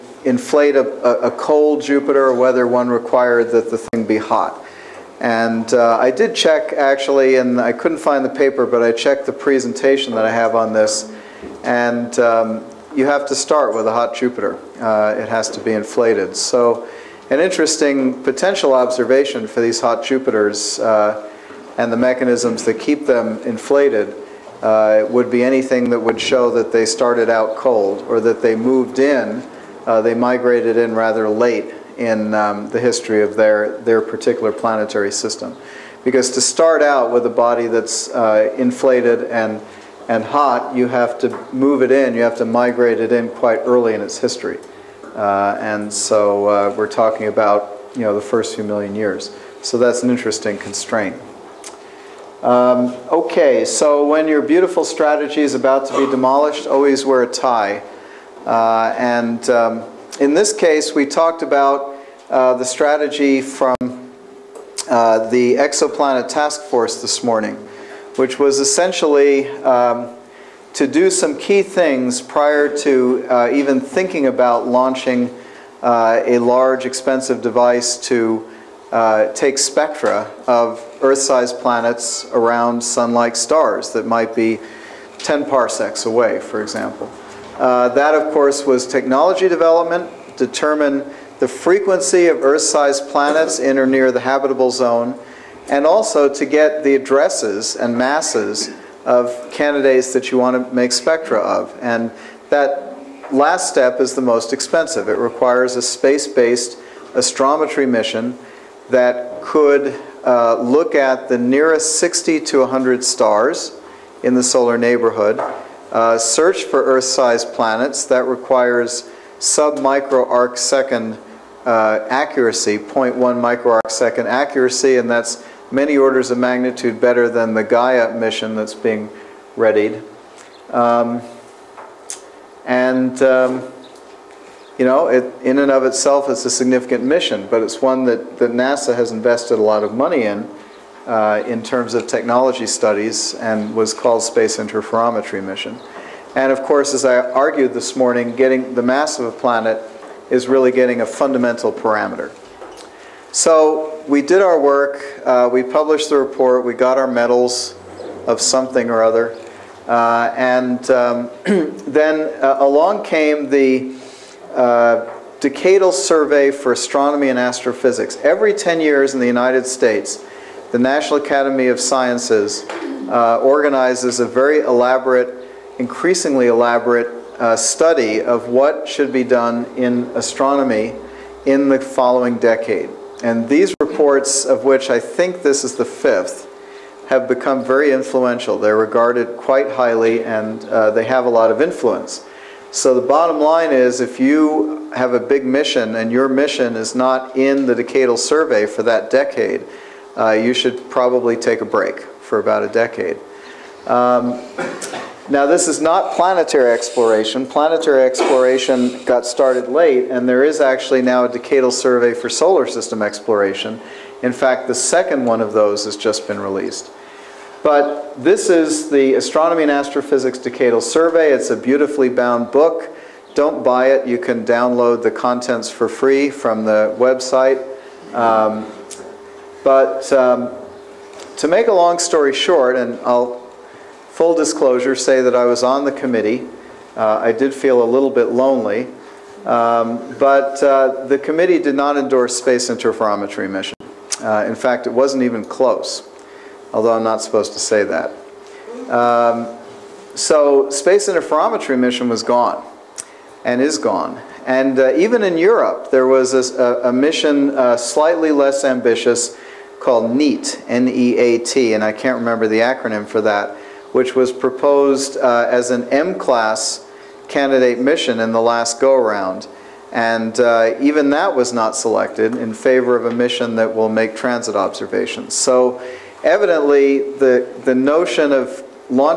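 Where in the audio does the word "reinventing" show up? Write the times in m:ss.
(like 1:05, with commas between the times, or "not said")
not said.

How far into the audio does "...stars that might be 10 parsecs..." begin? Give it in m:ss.
1:23.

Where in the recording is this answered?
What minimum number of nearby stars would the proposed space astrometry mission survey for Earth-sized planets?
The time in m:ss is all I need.
1:51.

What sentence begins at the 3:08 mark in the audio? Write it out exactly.
They're regarded quite highly and uh, they have a lot of influence.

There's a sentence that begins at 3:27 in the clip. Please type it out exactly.
Planetary exploration got started late, and there is actually now a decadal survey for solar system exploration.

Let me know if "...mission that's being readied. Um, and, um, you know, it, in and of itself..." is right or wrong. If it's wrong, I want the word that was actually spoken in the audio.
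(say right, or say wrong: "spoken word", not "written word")
right.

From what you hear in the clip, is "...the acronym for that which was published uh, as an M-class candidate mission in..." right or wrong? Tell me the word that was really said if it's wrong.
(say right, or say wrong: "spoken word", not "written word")
wrong: "proposed", not "published".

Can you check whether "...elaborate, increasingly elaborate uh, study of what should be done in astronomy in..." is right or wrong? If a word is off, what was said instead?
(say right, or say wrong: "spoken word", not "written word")
right.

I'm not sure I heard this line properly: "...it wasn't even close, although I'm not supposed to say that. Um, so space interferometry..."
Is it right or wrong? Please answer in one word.
right.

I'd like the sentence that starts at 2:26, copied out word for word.
And of course, as I argued this morning, getting the mass of a planet is really getting a fundamental parameter.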